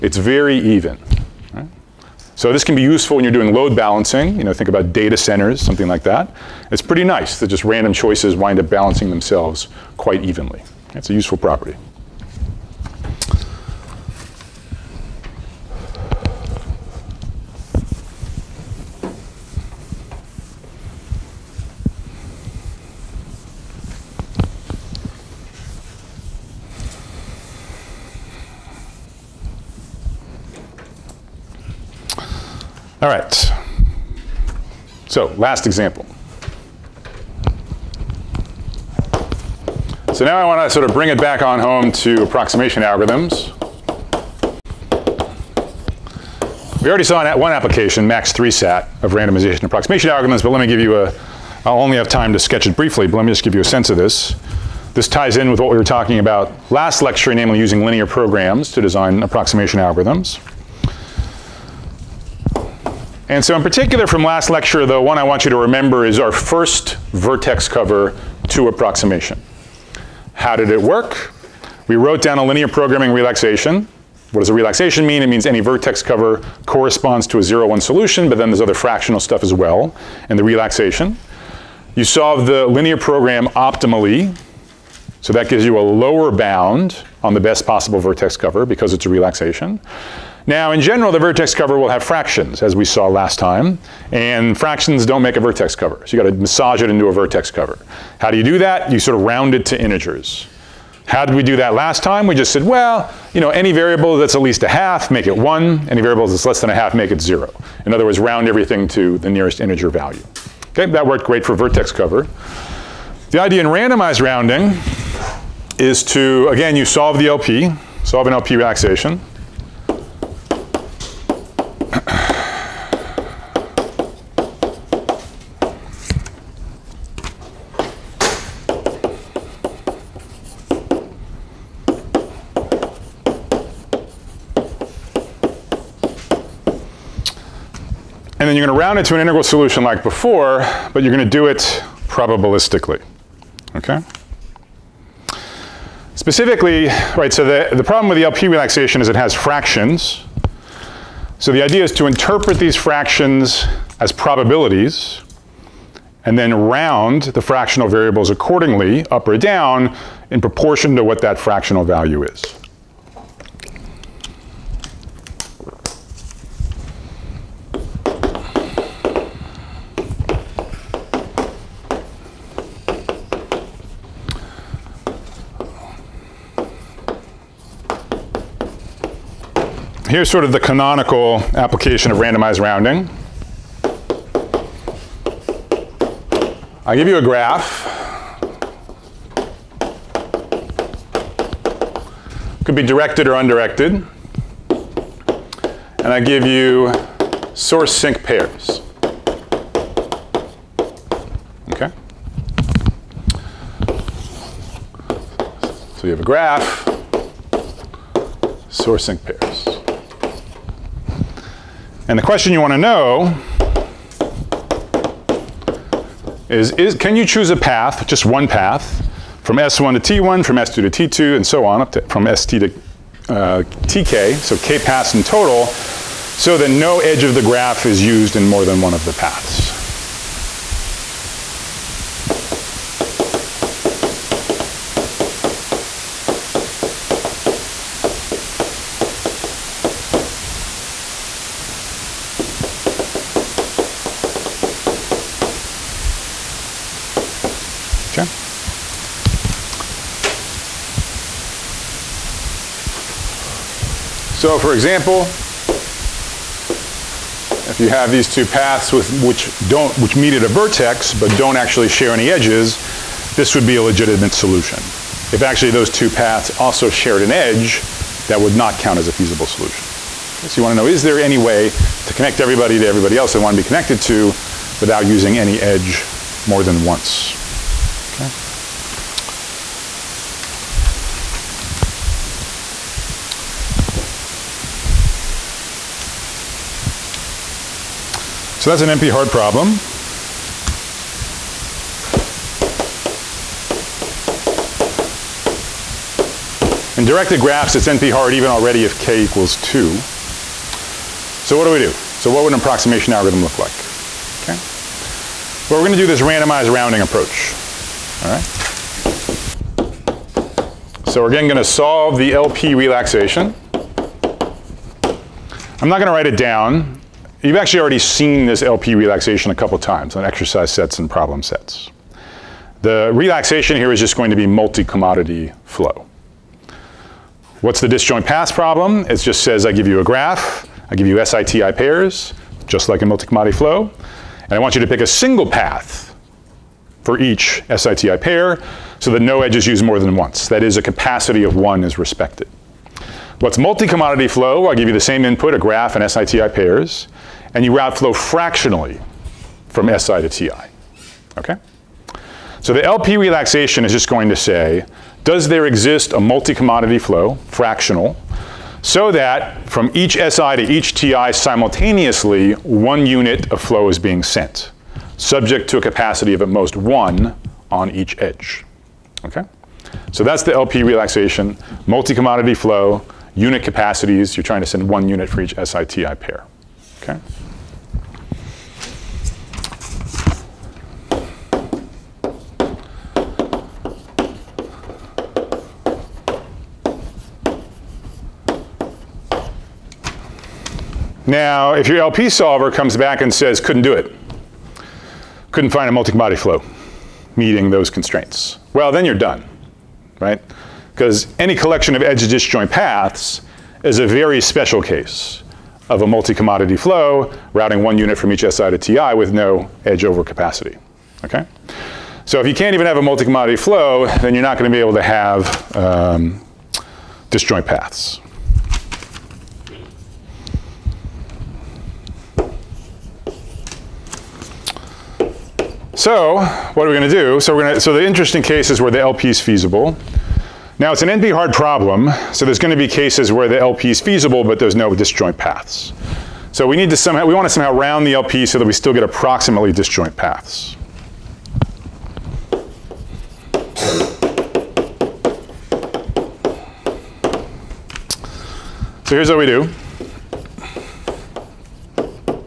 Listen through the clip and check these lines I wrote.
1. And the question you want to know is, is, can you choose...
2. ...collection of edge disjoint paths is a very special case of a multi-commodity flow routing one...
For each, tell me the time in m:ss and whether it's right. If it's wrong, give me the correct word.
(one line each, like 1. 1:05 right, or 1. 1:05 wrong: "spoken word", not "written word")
1. 3:32 right
2. 6:41 right.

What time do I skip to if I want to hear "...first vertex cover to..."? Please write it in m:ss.
1:06.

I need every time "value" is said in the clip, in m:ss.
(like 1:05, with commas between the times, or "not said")
1:49, 2:41.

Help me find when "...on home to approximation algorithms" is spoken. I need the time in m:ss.
0:41.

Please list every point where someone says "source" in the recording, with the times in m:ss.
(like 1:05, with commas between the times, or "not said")
3:17, 3:28.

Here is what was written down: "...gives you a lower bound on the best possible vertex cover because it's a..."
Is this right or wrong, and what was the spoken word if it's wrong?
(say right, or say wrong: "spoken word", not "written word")
right.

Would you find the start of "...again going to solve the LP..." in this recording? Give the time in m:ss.
5:11.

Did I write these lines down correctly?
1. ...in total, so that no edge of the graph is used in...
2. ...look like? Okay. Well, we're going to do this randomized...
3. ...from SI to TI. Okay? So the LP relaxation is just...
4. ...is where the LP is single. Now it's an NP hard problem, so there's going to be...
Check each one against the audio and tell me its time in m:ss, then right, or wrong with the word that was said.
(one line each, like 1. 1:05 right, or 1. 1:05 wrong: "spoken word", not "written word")
1. 3:45 right
2. 5:03 right
3. 5:49 right
4. 7:08 wrong: "feasible", not "single".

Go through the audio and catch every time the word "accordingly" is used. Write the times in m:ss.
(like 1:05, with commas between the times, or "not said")
2:38.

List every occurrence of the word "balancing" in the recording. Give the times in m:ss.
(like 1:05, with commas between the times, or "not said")
0:03, 0:08.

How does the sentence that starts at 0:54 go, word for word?
This ties in with what we were talking about last lecture, namely using linear programs to design approximation algorithms.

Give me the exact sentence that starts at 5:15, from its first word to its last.
I'm not going to write it down.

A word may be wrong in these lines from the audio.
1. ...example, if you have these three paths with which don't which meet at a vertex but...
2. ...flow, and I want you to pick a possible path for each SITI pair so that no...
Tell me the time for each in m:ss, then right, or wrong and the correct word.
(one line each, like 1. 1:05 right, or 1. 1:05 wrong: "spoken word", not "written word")
1. 4:14 wrong: "two", not "three"
2. 5:33 wrong: "single", not "possible".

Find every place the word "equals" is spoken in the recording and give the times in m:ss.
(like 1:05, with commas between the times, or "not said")
4:59.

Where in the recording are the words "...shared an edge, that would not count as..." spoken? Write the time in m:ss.
4:26.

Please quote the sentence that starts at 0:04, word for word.
You know, think about data centers, something like that.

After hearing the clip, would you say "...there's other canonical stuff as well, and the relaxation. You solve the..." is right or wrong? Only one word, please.
wrong.